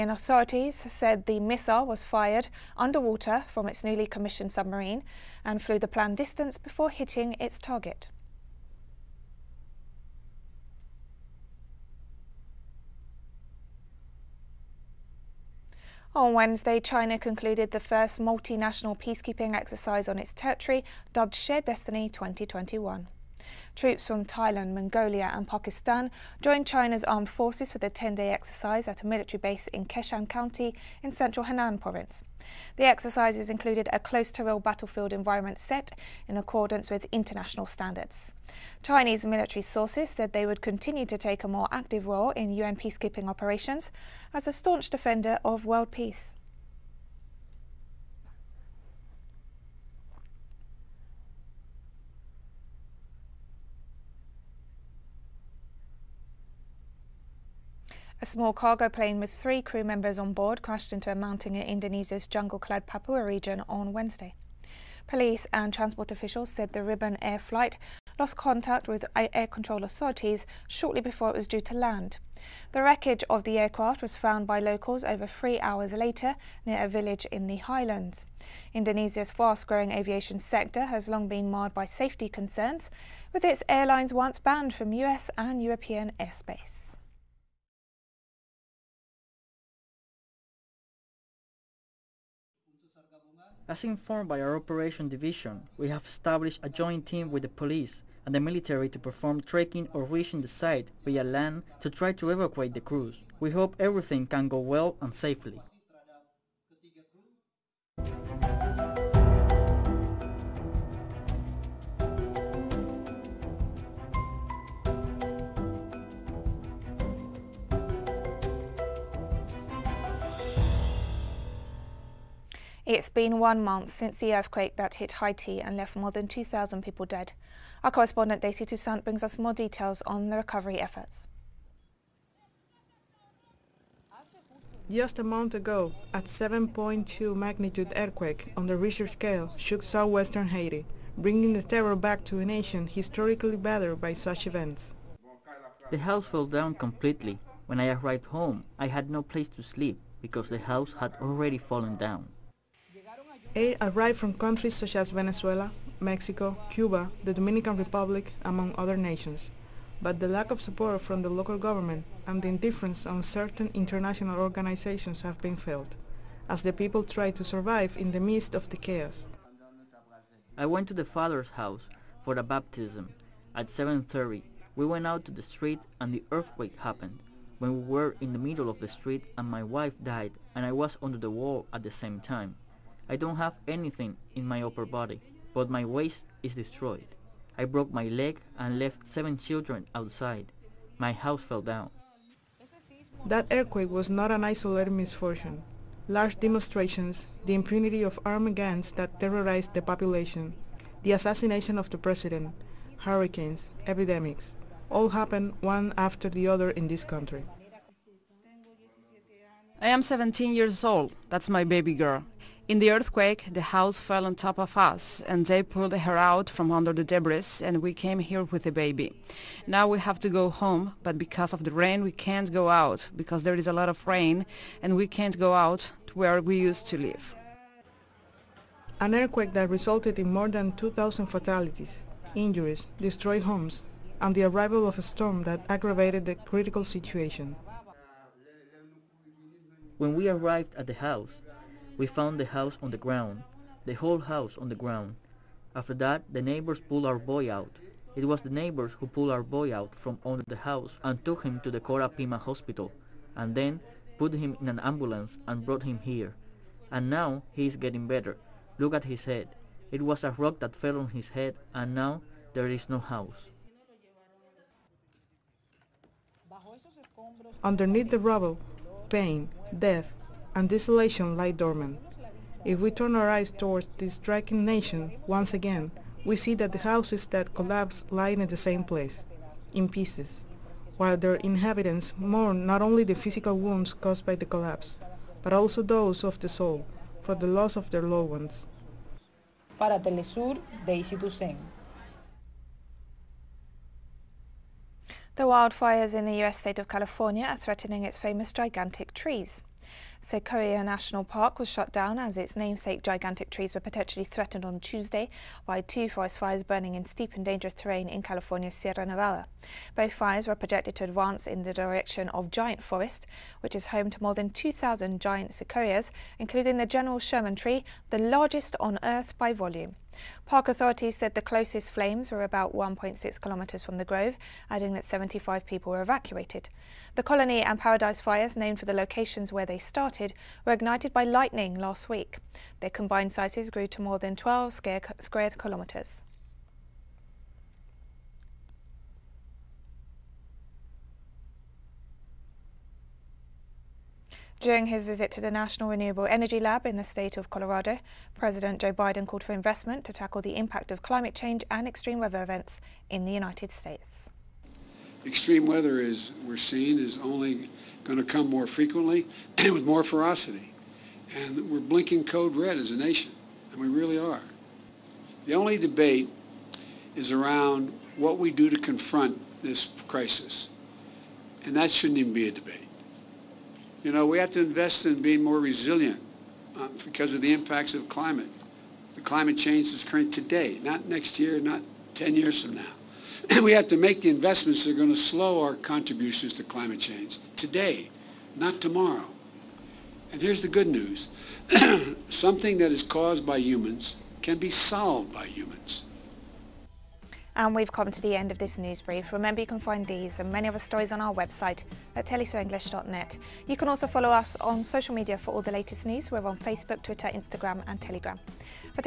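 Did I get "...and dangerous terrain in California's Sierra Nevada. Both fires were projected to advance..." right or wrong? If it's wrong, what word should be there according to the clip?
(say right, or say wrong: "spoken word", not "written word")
right.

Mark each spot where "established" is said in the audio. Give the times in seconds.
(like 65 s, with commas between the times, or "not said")
96 s.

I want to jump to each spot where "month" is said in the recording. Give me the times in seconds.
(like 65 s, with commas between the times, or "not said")
123 s, 135 s.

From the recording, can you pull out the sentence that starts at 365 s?
The only debate is around what we do to confront this crisis.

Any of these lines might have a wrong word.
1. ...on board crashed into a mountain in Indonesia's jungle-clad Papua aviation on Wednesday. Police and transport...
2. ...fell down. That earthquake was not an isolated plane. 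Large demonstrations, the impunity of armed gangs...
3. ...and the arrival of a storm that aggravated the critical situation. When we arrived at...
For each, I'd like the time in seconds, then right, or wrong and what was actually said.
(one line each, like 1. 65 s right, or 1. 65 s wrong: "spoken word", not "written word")
1. 60 s wrong: "region", not "aviation"
2. 191 s wrong: "misfortune", not "plane"
3. 234 s right.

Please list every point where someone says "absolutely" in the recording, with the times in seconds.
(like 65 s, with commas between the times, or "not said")
not said.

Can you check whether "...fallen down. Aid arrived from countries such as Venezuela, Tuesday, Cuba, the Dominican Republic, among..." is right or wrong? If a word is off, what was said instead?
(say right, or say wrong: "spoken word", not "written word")
wrong: "Mexico", not "Tuesday".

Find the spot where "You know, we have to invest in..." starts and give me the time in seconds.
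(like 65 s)
374 s.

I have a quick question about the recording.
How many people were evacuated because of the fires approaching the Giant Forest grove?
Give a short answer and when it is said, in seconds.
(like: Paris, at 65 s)
75, at 325 s.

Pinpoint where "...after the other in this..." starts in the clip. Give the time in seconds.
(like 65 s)
205 s.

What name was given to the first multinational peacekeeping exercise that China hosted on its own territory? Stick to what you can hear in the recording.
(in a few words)
Shared Destiny 2021.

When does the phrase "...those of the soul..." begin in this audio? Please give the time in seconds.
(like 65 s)
285 s.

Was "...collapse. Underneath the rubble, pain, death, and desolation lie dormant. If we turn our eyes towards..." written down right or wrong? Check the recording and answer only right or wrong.
wrong.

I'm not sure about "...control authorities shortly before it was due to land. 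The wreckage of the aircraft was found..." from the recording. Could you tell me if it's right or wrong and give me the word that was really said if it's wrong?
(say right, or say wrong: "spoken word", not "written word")
right.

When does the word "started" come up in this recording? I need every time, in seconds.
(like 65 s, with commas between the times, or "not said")
329 s.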